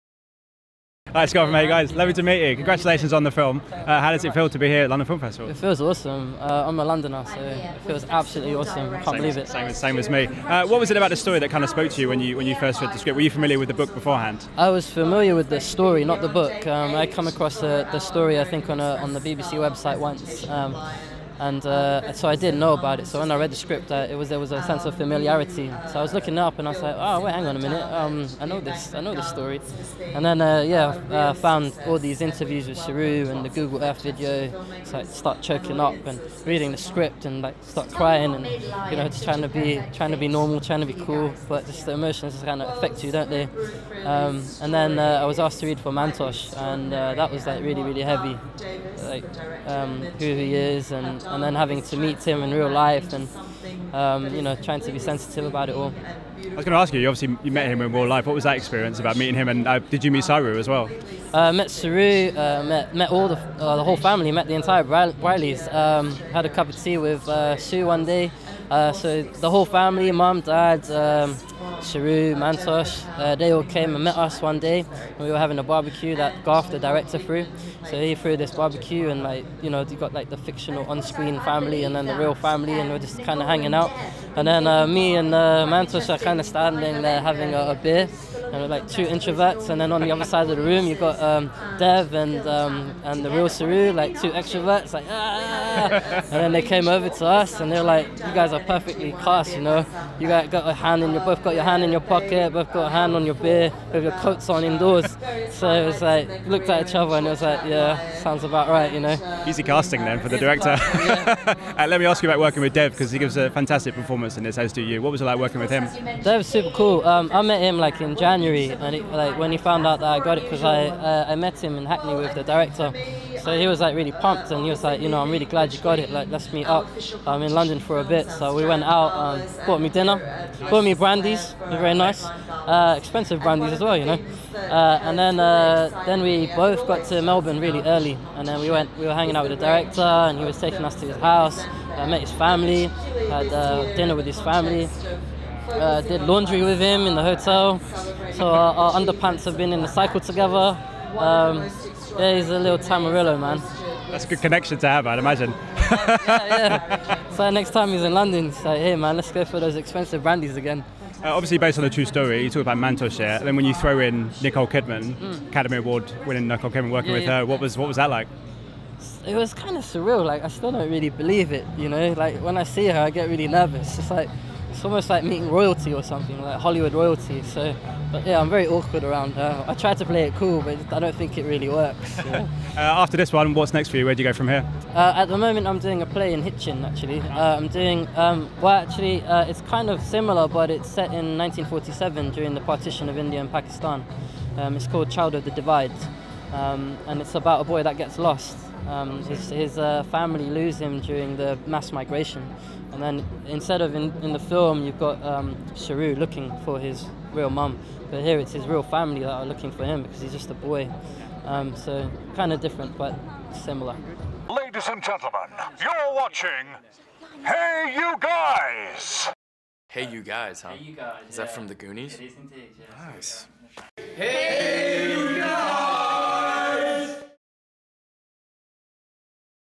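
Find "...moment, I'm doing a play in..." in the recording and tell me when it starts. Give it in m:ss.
3:05.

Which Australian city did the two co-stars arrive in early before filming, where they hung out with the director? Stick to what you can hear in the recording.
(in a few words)
Melbourne.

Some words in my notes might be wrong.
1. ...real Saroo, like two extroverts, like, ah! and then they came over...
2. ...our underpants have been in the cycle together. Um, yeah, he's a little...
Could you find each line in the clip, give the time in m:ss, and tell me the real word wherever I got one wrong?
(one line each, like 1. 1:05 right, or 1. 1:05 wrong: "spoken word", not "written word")
1. 1:33 right
2. 2:28 right.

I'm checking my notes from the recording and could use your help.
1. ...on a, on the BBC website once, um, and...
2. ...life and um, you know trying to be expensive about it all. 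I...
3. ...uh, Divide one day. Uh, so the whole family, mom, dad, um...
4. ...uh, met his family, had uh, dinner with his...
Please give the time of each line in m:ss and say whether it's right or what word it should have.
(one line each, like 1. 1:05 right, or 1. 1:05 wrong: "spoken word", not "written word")
1. 0:18 right
2. 0:52 wrong: "sensitive", not "expensive"
3. 1:07 wrong: "Sue", not "Divide"
4. 2:22 right.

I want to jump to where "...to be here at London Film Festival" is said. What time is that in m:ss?
0:04.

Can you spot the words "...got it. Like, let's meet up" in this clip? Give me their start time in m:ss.
2:05.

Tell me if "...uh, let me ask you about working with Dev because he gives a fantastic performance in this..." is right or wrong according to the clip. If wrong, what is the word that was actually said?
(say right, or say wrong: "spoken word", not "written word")
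right.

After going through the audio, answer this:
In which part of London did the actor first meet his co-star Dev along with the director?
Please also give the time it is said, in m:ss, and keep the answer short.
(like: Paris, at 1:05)
Hackney, at 2:01.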